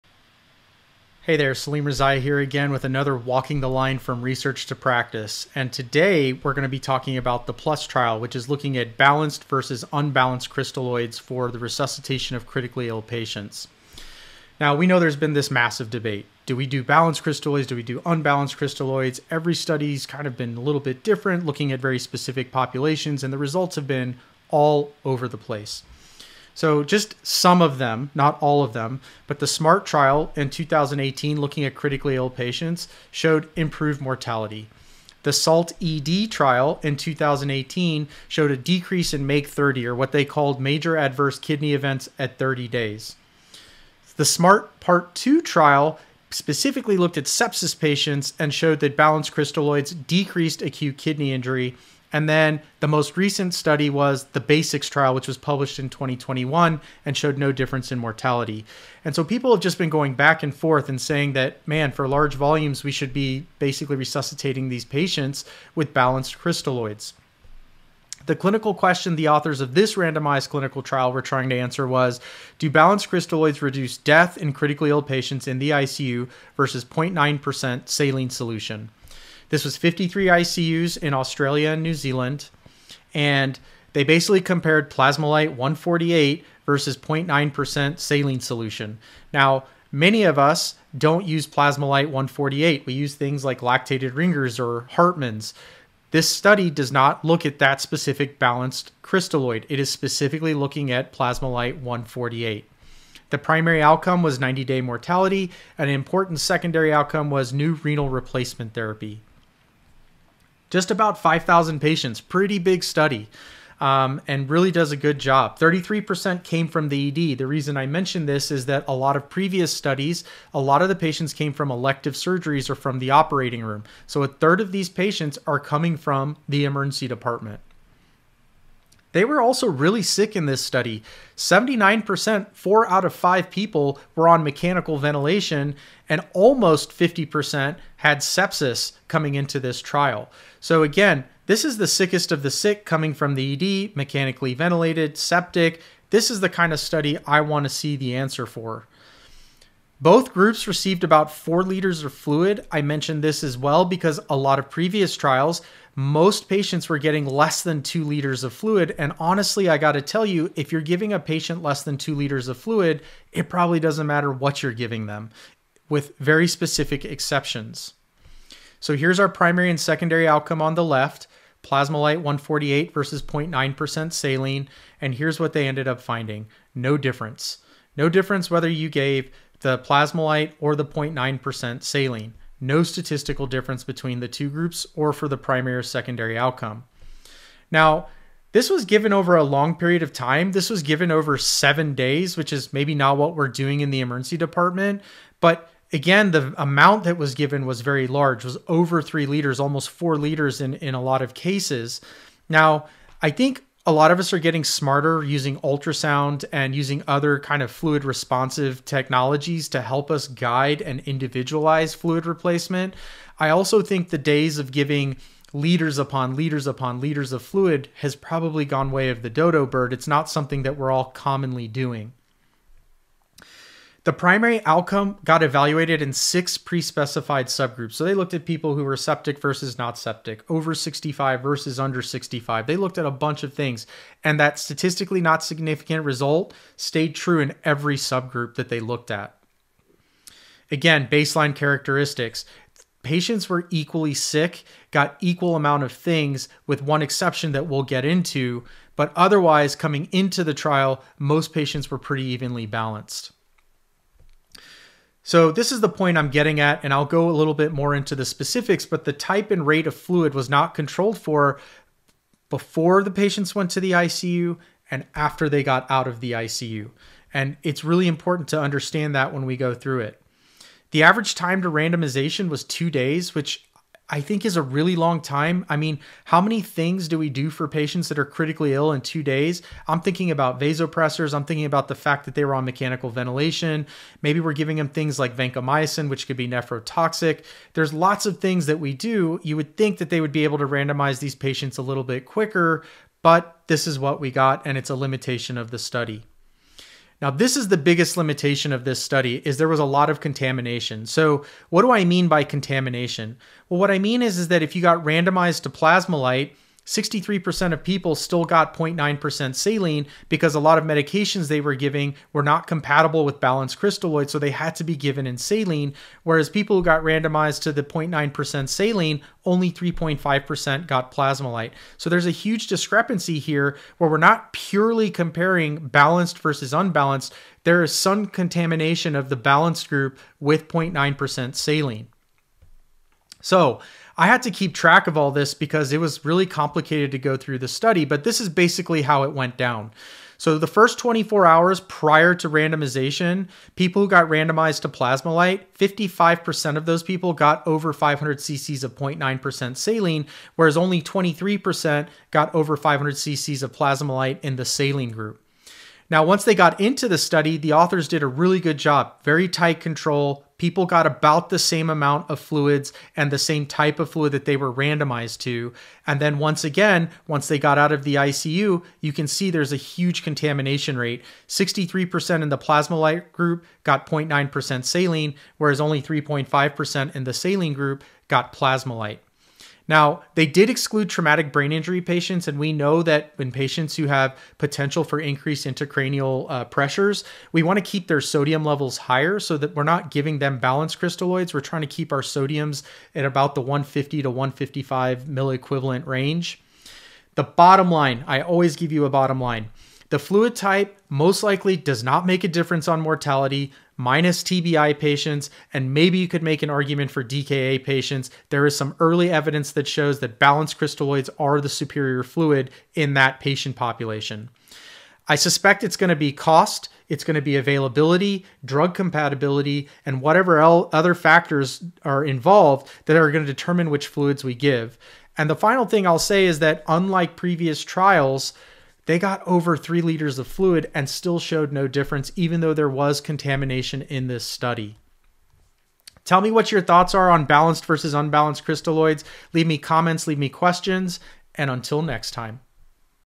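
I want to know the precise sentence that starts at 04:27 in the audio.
And it's really important to understand that when we go through it.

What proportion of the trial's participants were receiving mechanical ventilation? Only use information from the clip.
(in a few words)
79%.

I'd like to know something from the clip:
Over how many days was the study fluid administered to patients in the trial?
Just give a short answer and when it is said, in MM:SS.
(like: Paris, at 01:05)
7 days, at 03:11.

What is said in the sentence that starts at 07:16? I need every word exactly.
Tell me what your thoughts are on balanced versus unbalanced crystalloids.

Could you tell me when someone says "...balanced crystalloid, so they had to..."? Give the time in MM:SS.
05:13.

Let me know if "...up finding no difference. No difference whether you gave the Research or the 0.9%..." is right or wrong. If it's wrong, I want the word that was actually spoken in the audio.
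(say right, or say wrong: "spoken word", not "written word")
wrong: "Plasmalyte", not "Research".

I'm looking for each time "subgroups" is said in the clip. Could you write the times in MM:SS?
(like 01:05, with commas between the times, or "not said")
03:47, 03:57.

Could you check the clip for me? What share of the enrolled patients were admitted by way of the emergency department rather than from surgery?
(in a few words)
33%.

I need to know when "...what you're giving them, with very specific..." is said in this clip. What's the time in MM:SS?
02:44.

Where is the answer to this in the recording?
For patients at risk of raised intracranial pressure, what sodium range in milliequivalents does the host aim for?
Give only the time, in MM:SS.
06:33.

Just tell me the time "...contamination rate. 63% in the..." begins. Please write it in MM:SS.
06:10.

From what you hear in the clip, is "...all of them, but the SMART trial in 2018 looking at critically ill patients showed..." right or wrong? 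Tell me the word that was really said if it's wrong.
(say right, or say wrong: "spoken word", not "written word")
right.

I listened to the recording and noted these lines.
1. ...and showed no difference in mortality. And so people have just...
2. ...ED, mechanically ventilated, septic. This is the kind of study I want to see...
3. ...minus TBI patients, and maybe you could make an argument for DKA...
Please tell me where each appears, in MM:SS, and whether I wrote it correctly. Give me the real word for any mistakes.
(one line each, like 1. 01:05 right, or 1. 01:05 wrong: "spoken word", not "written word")
1. 00:57 right
2. 02:23 right
3. 06:43 right.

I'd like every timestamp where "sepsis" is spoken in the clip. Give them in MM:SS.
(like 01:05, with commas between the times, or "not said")
00:47, 02:18.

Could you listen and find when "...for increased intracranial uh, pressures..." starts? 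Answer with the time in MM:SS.
06:25.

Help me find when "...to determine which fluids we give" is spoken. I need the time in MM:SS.
07:03.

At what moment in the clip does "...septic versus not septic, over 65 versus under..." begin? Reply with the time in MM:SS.
03:48.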